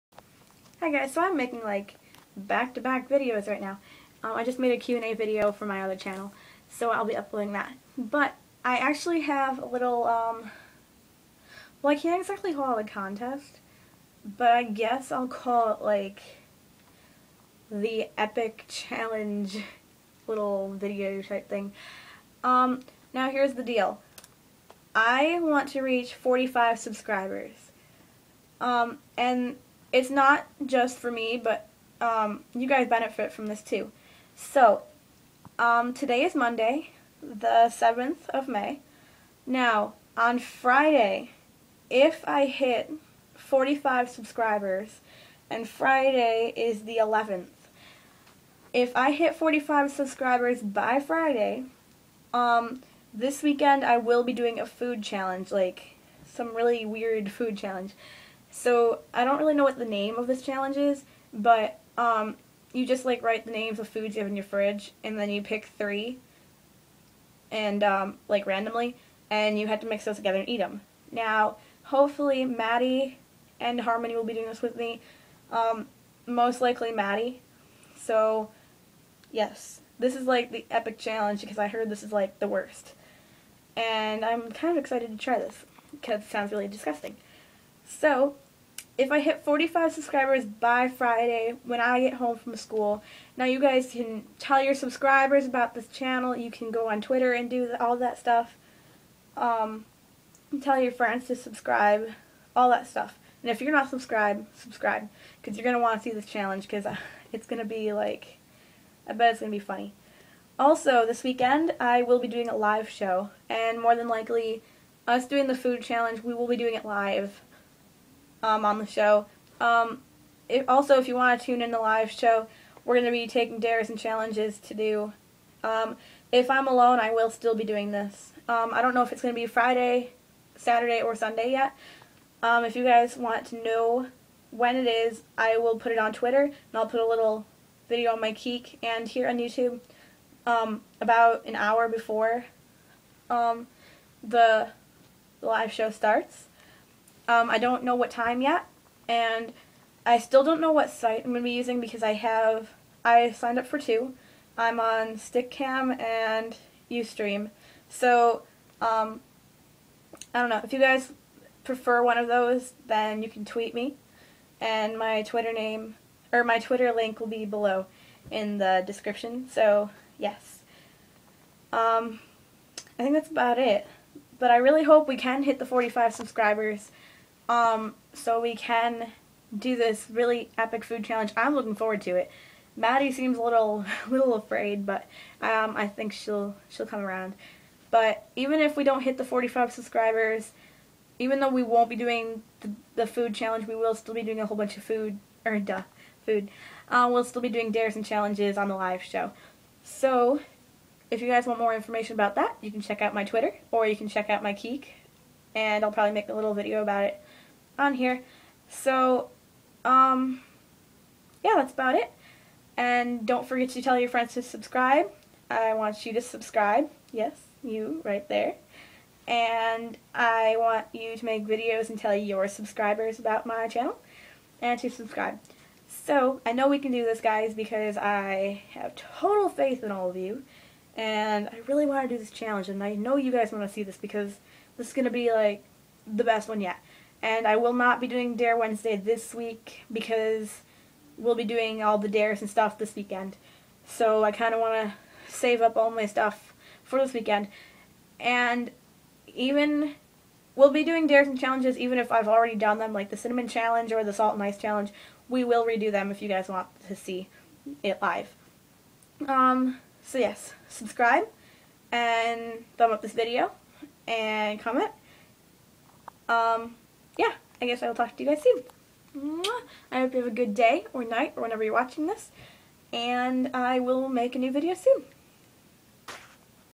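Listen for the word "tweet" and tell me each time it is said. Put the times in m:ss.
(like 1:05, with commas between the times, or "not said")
2:43.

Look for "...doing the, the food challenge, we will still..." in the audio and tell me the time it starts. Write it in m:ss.
3:11.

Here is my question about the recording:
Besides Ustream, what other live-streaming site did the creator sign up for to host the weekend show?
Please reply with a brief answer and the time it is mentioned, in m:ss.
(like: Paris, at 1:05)
Stickcam, at 2:35.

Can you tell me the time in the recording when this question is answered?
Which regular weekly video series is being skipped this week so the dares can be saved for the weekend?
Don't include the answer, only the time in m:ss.
3:58.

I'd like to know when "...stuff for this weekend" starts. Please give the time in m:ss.
4:06.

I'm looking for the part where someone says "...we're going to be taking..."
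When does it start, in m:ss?
2:02.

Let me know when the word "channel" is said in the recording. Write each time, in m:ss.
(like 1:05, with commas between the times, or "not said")
0:05, 1:35, 3:43.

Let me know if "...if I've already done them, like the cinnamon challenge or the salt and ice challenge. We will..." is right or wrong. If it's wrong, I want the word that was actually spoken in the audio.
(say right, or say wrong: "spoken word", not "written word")
right.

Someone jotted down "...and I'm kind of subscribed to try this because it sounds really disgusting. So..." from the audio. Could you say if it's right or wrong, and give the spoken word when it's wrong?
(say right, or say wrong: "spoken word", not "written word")
wrong: "excited", not "subscribed".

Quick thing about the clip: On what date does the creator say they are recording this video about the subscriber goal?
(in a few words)
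7th of May.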